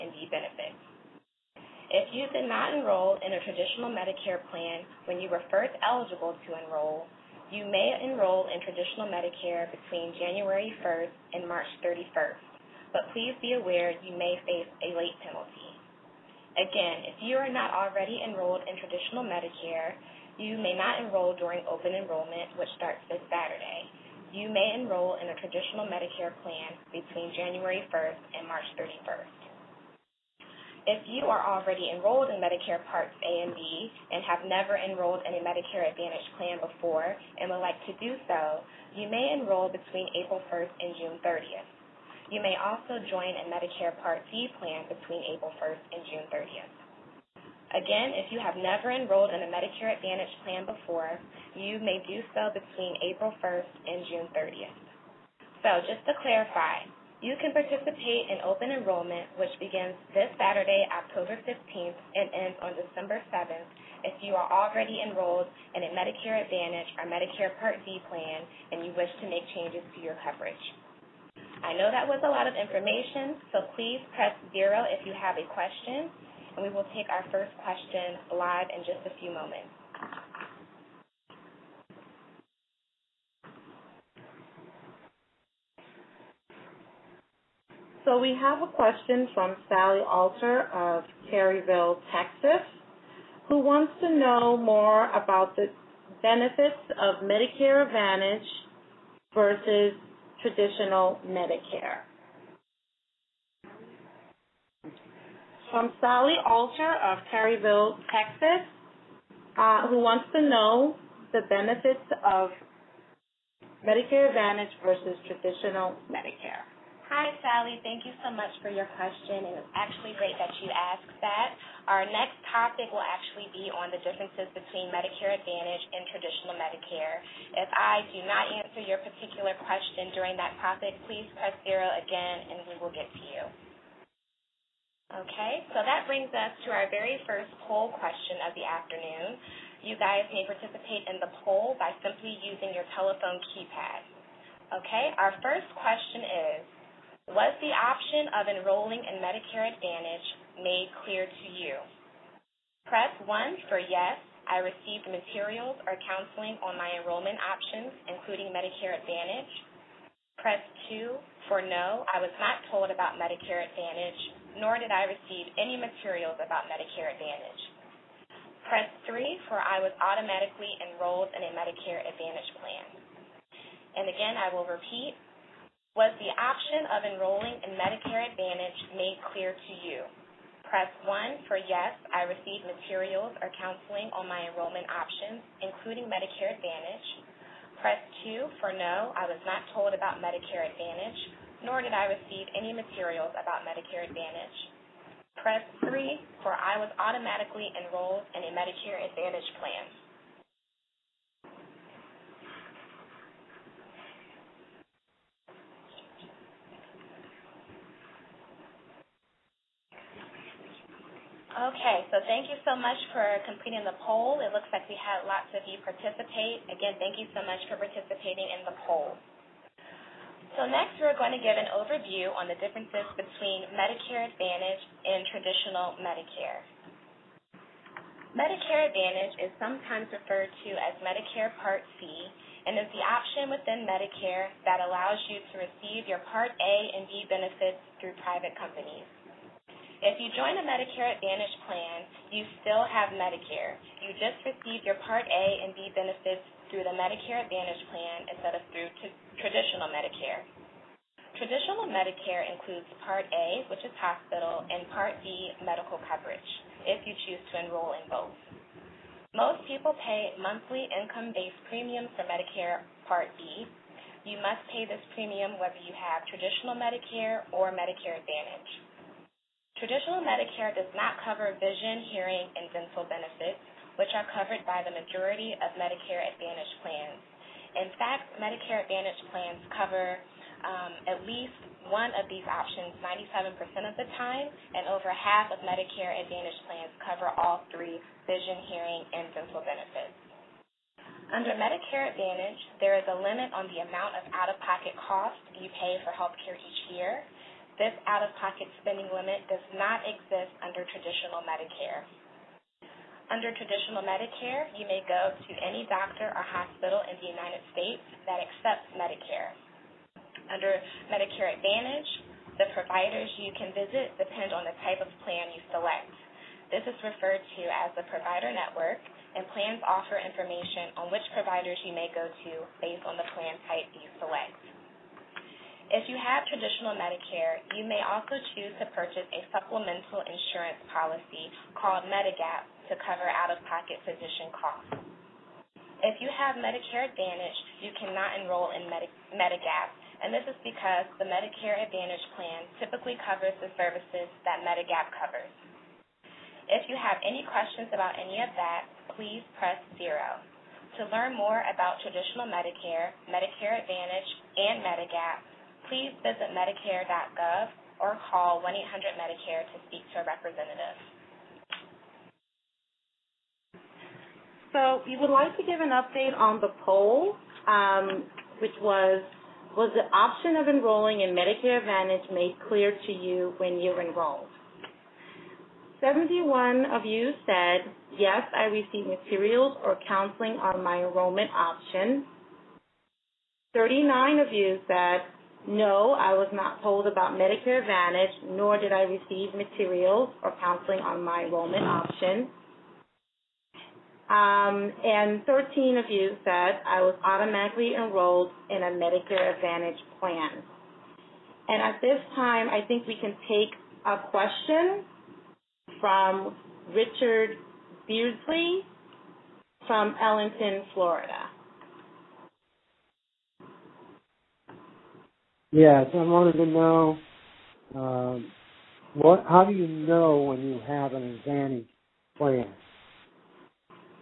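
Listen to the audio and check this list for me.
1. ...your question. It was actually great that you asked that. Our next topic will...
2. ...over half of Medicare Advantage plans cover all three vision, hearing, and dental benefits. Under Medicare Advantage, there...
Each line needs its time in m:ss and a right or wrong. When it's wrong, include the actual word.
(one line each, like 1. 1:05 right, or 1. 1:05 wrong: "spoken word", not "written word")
1. 1:58 right
2. 4:44 right.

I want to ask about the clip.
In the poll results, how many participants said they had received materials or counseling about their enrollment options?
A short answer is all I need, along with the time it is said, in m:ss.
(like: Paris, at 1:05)
71, at 6:16.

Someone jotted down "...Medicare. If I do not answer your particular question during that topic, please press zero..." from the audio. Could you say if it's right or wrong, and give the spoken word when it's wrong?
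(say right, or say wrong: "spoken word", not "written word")
right.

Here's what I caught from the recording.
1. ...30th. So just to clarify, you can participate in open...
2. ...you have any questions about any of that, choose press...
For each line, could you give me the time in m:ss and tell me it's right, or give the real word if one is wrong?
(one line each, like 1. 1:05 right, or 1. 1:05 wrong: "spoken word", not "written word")
1. 0:54 right
2. 5:46 wrong: "please", not "choose".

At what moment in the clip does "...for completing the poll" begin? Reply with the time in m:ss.
3:33.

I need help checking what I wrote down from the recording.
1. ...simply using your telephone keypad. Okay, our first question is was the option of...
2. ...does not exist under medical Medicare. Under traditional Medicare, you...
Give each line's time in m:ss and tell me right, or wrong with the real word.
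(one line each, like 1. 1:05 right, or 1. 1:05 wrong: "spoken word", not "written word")
1. 2:22 right
2. 4:59 wrong: "traditional", not "medical".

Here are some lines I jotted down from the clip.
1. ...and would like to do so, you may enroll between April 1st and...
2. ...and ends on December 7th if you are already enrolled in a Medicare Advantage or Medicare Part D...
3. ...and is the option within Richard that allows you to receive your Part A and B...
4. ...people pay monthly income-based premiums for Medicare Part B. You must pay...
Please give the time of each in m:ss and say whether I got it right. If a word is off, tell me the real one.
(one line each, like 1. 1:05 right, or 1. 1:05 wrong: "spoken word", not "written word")
1. 0:37 right
2. 1:02 right
3. 3:52 wrong: "Medicare", not "Richard"
4. 4:19 right.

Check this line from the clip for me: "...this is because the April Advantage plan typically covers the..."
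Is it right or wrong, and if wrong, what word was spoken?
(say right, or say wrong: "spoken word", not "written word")
wrong: "Medicare", not "April".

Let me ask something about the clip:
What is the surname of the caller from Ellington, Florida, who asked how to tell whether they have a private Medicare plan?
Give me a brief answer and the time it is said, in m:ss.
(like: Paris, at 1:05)
Beardsley, at 6:46.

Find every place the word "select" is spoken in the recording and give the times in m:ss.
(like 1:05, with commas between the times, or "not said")
5:15, 5:24.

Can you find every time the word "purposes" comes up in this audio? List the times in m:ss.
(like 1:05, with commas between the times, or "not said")
not said.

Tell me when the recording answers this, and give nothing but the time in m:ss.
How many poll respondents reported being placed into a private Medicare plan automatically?
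6:35.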